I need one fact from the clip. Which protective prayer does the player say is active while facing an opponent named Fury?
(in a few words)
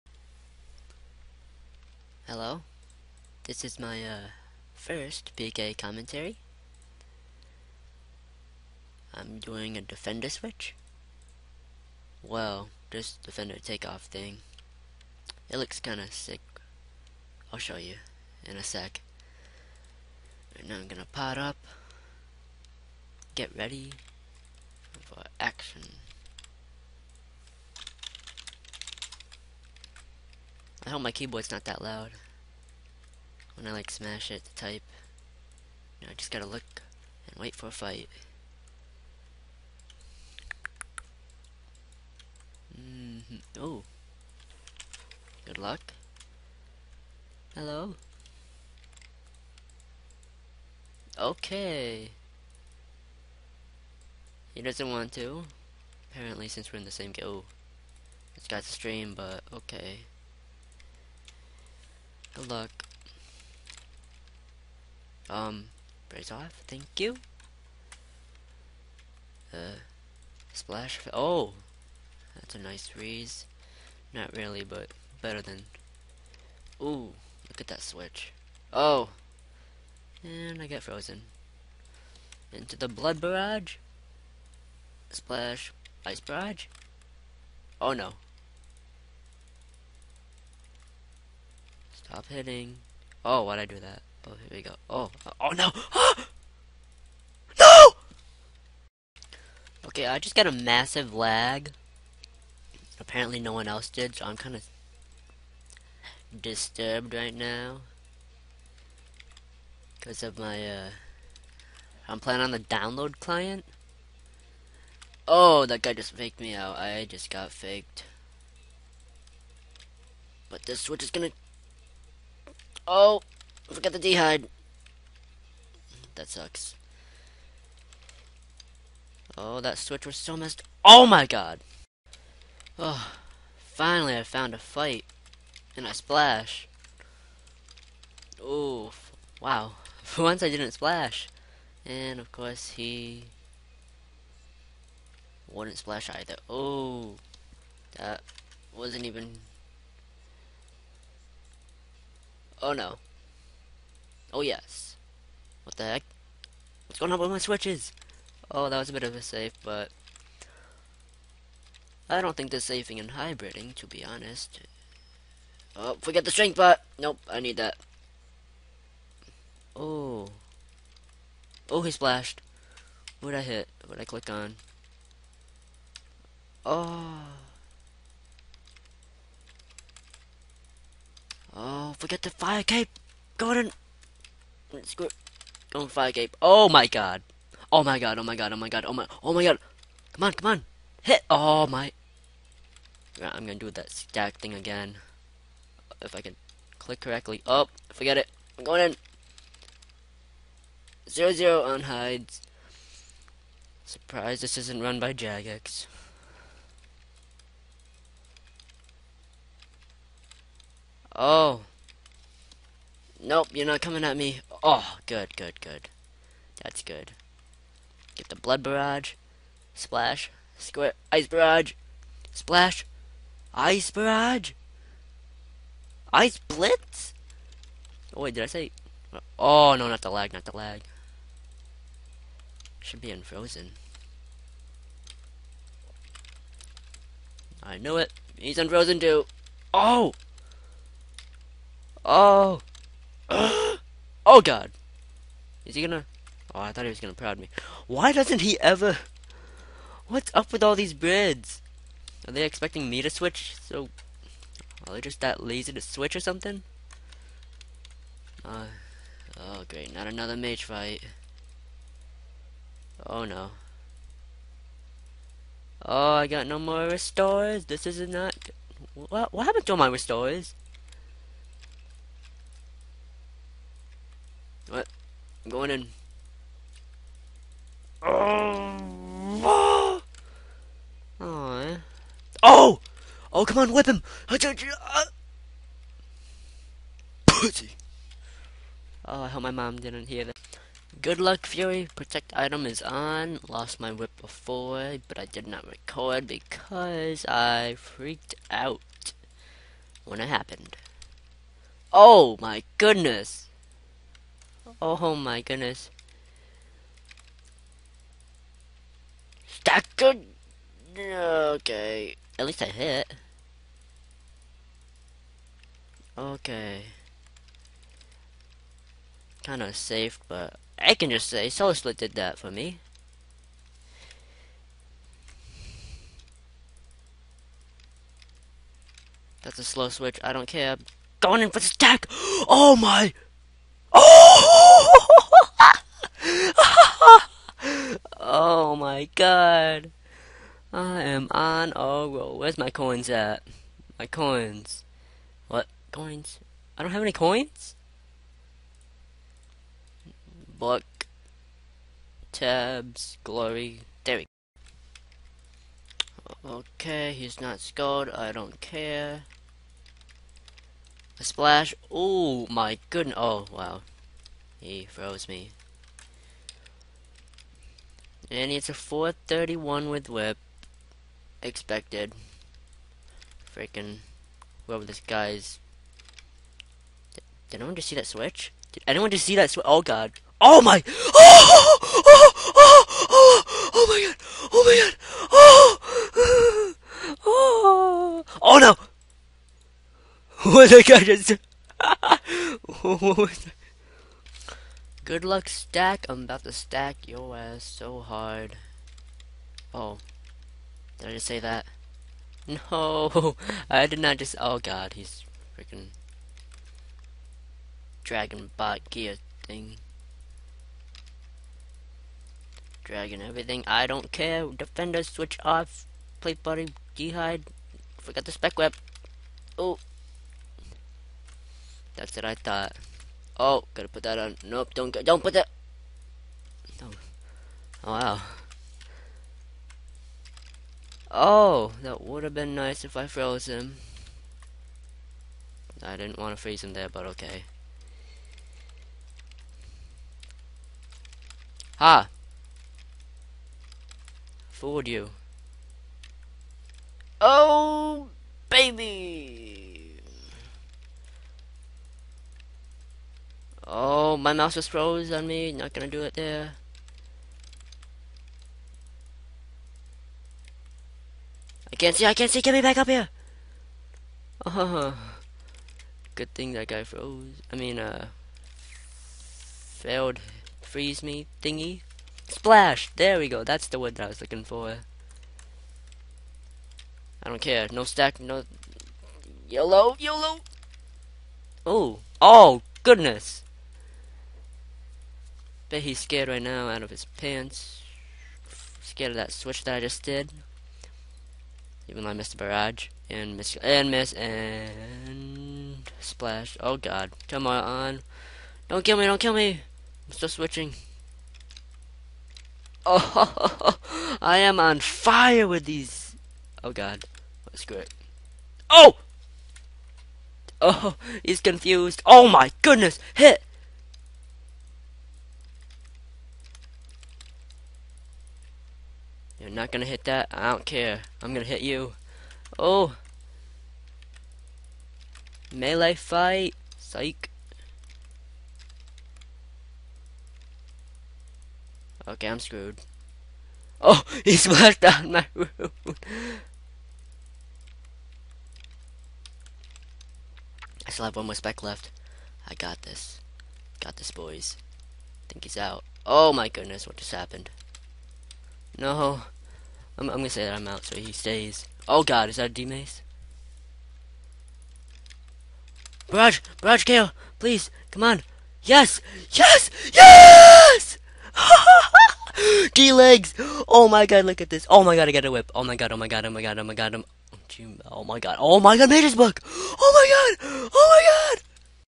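Protect item.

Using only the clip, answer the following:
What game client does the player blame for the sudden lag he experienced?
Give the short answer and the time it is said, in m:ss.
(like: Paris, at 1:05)
download client, at 1:52.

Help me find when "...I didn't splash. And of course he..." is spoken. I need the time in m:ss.
2:20.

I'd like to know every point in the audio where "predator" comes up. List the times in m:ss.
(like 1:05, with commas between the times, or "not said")
not said.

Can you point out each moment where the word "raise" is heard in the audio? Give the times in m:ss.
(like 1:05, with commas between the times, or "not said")
1:06, 1:12.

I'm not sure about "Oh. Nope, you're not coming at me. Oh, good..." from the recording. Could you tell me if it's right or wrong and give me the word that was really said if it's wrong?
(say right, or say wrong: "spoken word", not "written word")
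right.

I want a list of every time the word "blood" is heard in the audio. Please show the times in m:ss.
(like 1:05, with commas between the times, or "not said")
1:22, 3:38.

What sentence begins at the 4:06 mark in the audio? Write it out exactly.
Oh, I thought he was gonna proud me.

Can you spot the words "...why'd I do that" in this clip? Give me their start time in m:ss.
1:33.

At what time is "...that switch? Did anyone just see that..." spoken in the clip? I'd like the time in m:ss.
6:17.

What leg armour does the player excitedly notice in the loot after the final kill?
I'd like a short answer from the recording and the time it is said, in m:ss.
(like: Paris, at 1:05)
D-Legs, at 9:22.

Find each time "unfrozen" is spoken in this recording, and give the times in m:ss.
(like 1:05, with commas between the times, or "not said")
3:53, 3:58.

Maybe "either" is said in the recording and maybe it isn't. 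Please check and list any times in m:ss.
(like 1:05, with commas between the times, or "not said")
2:26.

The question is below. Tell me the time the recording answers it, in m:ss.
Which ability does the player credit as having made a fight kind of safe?
5:21.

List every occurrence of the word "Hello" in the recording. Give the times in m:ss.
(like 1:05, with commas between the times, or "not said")
0:02, 0:47.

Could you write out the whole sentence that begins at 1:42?
Apparently no one else did, so I'm kind of disturbed right now.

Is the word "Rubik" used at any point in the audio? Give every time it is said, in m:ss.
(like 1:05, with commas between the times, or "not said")
not said.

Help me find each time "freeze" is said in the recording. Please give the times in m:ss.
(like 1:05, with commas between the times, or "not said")
7:16, 7:50.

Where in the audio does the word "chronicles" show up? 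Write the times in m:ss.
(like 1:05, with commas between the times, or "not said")
not said.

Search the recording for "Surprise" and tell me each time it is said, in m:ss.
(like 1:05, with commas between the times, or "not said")
3:23.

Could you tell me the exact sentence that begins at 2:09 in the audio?
Oh, that switch was so messed.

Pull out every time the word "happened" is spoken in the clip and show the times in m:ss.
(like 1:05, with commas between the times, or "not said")
4:29, 5:00, 9:07.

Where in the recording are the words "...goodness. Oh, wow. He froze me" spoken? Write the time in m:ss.
6:02.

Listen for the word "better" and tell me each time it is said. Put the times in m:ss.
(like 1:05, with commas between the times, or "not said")
1:15.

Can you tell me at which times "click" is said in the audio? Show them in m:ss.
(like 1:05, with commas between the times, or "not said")
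2:54, 3:16.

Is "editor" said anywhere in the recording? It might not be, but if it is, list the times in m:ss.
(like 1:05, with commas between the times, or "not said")
not said.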